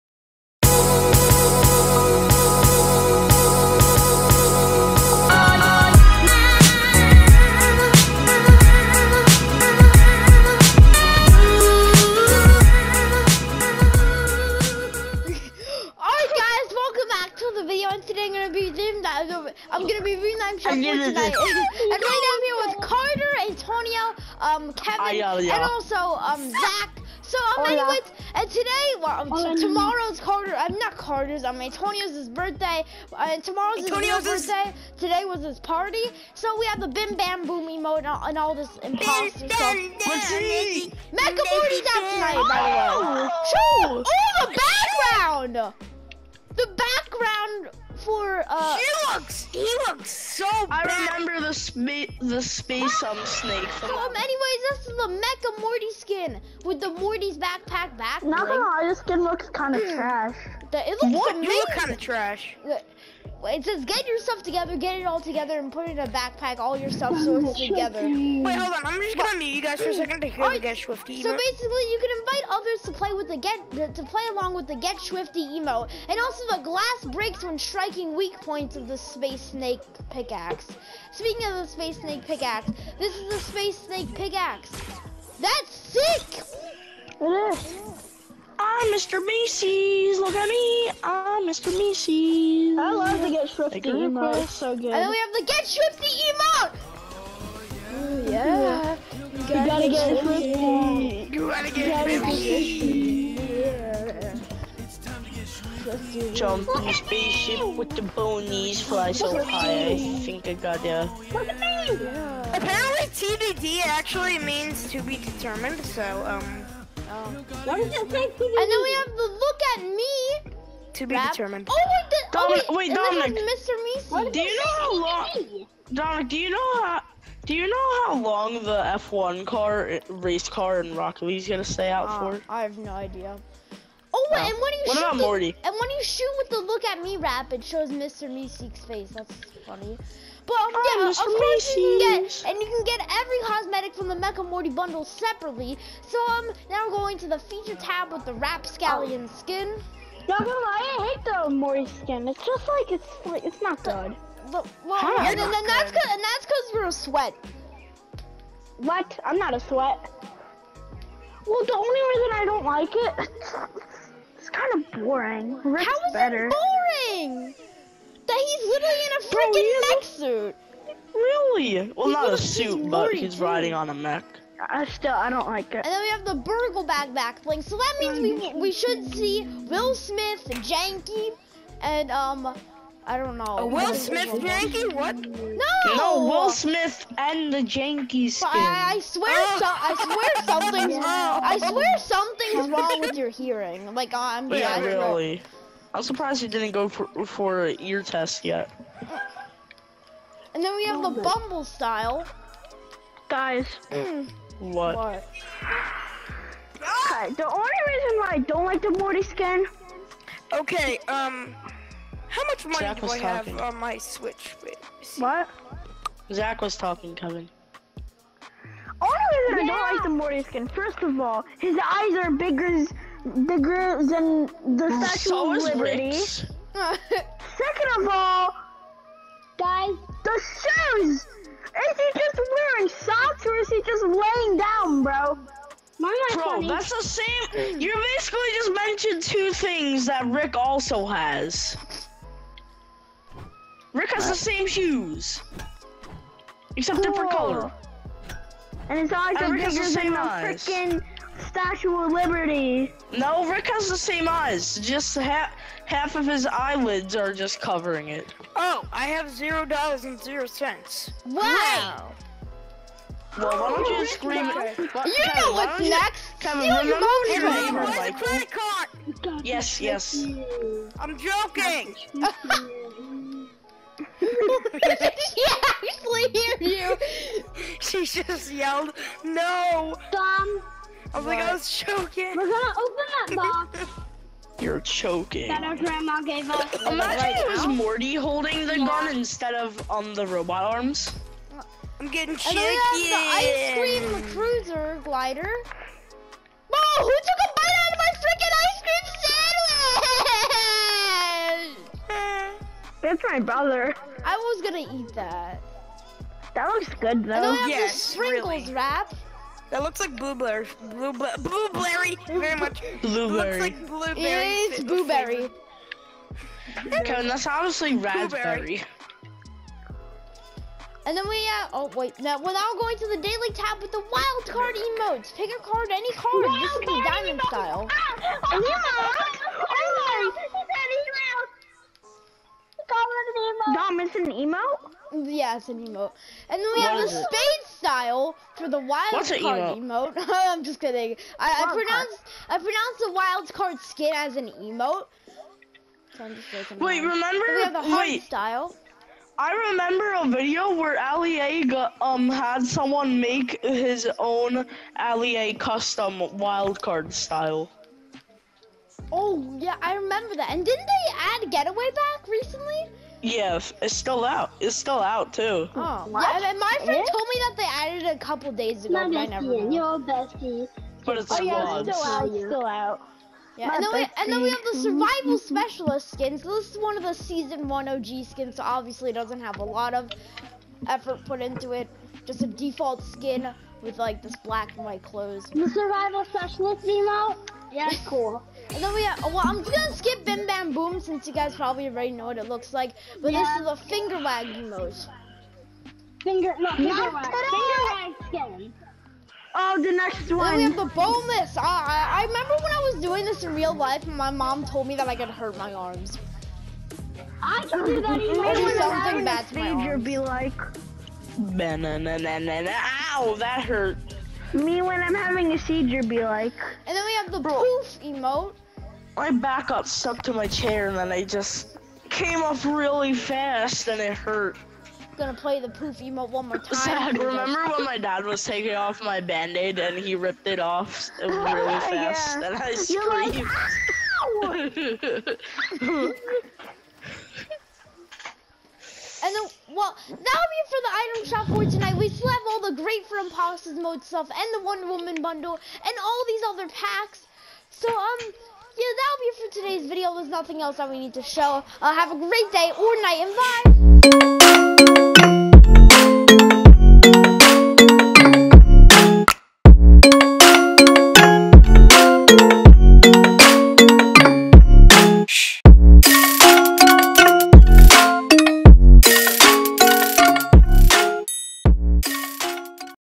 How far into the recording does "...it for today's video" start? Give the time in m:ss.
7:29.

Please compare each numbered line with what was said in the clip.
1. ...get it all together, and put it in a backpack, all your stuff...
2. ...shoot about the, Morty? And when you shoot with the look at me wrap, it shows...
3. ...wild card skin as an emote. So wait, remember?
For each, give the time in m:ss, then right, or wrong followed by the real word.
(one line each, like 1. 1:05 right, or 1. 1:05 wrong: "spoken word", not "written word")
1. 1:04 right
2. 2:14 right
3. 5:43 right.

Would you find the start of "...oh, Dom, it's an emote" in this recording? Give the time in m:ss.
5:32.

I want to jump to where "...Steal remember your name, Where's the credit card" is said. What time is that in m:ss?
4:26.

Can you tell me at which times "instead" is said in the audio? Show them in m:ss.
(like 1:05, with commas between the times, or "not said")
4:49.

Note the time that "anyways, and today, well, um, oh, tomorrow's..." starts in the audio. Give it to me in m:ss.
0:27.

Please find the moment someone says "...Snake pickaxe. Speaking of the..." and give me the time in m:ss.
1:19.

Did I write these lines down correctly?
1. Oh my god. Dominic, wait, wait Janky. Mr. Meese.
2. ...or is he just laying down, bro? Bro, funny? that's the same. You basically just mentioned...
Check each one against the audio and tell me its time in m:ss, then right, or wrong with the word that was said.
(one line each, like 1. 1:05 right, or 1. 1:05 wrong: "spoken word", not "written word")
1. 2:01 wrong: "Dominic", not "Janky"
2. 3:53 right.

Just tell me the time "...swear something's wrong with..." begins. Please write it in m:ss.
3:11.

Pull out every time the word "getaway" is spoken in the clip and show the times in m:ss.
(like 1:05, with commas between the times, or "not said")
6:01.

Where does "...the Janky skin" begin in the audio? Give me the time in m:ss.
3:07.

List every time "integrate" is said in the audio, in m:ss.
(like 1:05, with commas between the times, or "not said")
not said.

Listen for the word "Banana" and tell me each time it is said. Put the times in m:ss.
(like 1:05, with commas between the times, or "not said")
6:51.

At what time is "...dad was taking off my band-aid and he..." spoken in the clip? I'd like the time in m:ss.
7:08.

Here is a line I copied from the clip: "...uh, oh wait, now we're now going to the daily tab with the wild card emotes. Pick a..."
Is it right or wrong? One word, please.
right.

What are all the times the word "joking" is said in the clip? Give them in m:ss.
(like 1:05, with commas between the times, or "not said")
4:31.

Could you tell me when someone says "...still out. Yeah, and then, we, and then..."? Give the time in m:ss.
6:12.